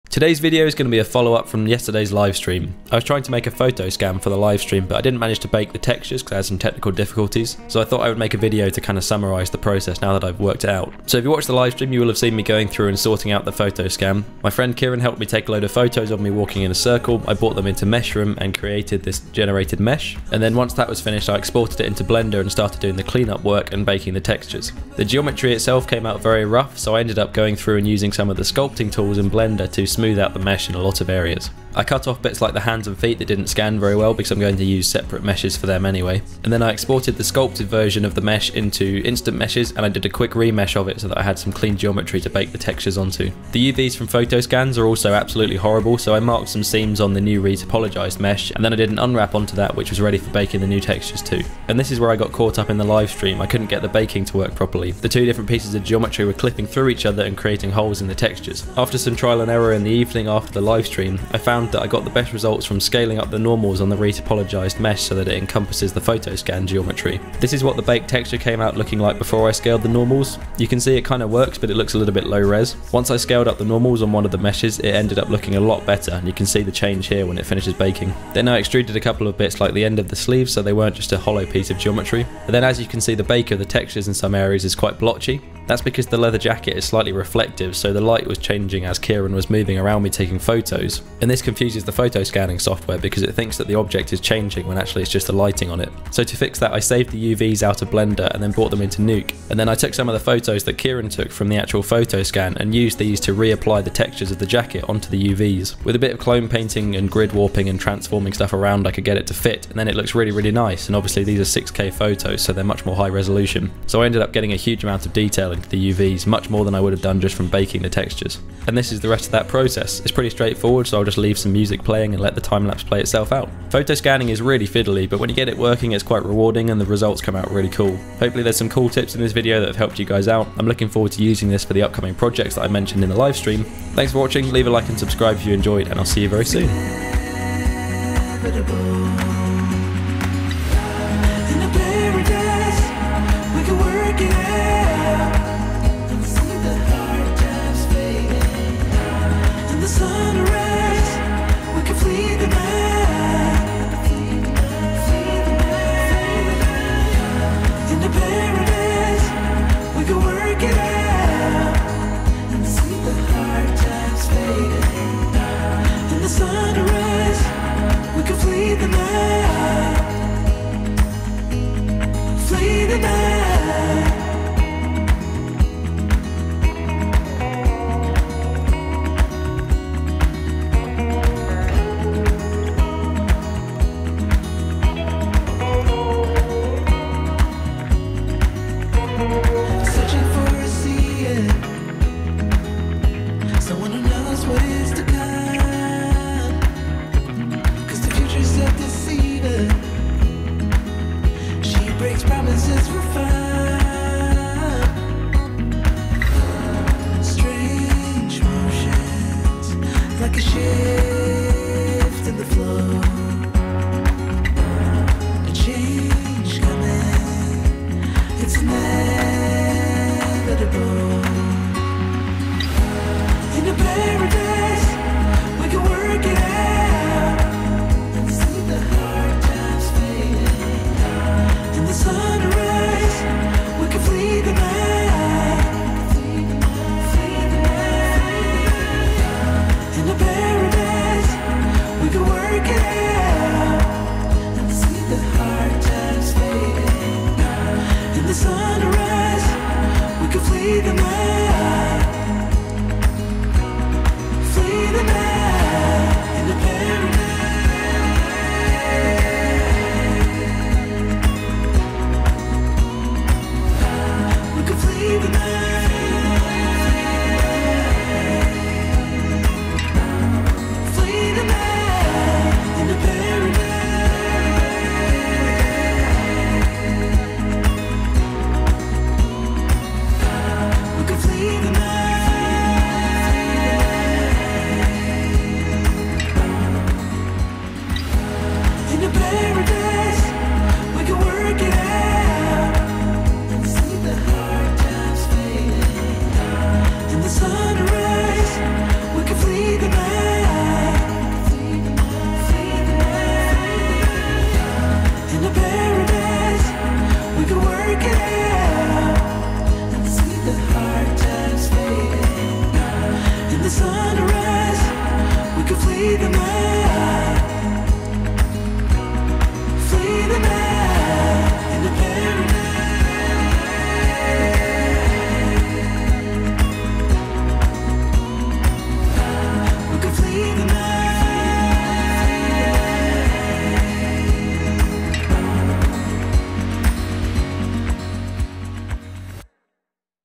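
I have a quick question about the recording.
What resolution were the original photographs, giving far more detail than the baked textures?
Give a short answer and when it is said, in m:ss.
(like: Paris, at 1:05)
6K, at 1:51.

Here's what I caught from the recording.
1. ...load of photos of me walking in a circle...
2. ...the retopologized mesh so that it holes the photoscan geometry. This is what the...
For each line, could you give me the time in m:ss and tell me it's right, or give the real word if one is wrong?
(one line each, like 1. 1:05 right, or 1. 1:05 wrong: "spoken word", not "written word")
1. 0:15 right
2. 1:03 wrong: "encompasses", not "holes".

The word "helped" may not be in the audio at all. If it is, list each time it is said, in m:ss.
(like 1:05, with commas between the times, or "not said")
0:14, 2:09.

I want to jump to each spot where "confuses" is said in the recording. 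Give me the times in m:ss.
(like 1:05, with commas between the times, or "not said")
1:31.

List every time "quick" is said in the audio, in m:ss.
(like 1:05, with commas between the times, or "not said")
0:40.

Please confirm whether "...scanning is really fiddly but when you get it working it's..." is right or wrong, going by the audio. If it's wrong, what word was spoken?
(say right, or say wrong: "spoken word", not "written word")
right.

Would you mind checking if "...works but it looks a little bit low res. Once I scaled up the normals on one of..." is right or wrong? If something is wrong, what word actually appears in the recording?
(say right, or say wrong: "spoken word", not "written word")
right.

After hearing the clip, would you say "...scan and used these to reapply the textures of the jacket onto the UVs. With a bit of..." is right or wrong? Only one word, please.
right.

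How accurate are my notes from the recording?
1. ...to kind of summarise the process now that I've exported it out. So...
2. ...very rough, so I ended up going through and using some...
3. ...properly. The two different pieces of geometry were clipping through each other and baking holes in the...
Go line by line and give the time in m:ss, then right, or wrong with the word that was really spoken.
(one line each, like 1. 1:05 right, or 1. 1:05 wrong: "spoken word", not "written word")
1. 0:08 wrong: "worked", not "exported"
2. 0:26 right
3. 0:54 wrong: "creating", not "baking".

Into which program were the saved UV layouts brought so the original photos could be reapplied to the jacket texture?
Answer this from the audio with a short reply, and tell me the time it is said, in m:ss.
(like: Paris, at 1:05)
Nuke, at 1:39.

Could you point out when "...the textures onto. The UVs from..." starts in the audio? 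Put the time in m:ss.
0:42.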